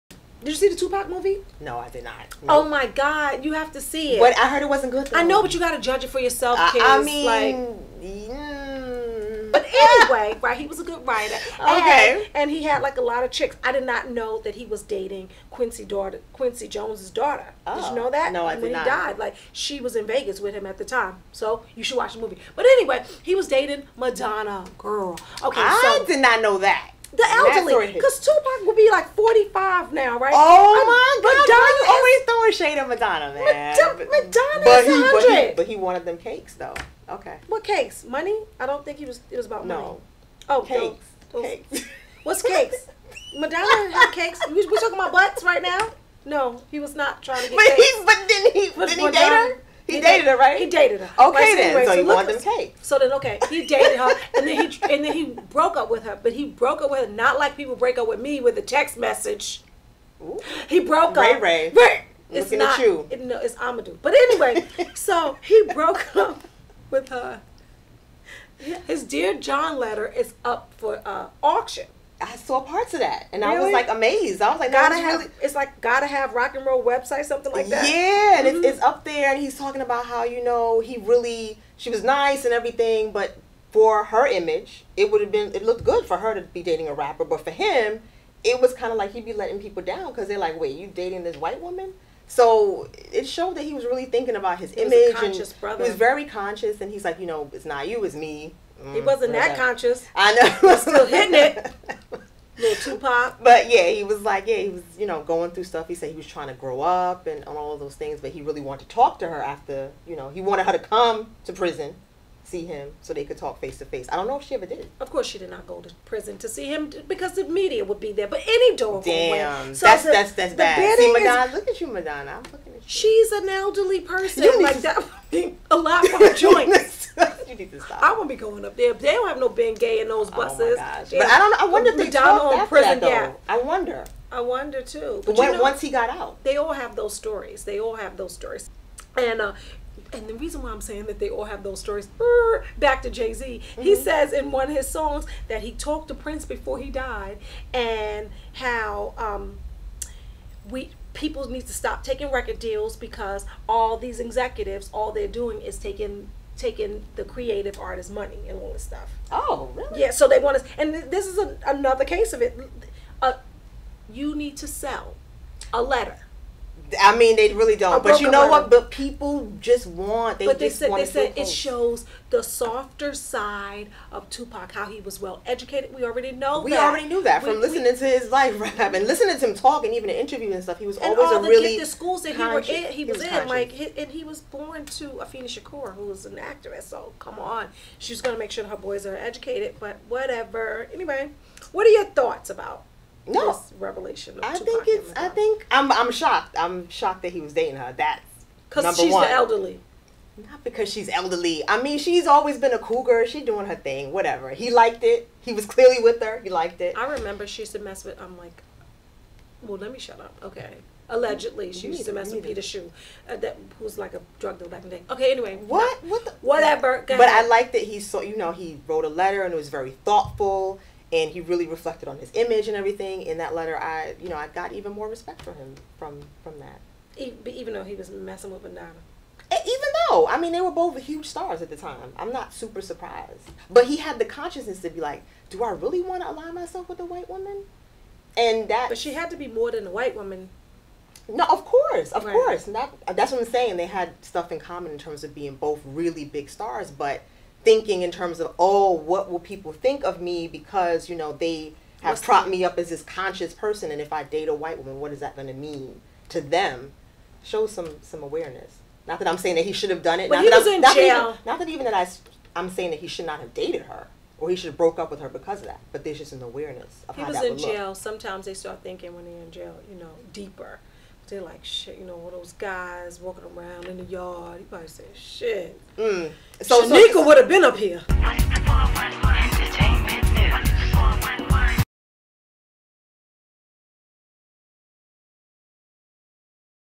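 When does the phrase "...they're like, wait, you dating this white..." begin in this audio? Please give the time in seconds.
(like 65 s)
90 s.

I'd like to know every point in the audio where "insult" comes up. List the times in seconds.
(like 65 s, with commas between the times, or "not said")
not said.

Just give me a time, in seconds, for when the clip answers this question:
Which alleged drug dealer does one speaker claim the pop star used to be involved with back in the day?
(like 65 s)
212 s.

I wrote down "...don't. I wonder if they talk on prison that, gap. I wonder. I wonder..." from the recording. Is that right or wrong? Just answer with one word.
right.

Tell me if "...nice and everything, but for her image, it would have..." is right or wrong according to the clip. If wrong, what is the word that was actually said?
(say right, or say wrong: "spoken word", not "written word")
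right.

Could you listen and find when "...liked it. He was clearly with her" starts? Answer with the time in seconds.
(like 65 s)
204 s.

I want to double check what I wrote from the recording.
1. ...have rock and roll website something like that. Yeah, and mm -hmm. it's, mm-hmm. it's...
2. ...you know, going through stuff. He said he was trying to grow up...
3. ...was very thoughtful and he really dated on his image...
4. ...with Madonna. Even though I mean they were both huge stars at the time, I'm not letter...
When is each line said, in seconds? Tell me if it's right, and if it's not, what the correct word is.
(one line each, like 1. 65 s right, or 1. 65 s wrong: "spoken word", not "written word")
1. 76 s right
2. 104 s right
3. 219 s wrong: "reflected", not "dated"
4. 228 s wrong: "super", not "letter".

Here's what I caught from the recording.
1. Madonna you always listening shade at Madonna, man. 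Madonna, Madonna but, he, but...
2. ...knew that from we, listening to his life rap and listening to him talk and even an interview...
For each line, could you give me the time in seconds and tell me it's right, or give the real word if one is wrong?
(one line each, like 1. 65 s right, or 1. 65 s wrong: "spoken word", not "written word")
1. 31 s wrong: "throwing", not "listening"
2. 177 s right.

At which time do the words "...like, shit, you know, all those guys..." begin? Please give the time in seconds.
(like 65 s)
271 s.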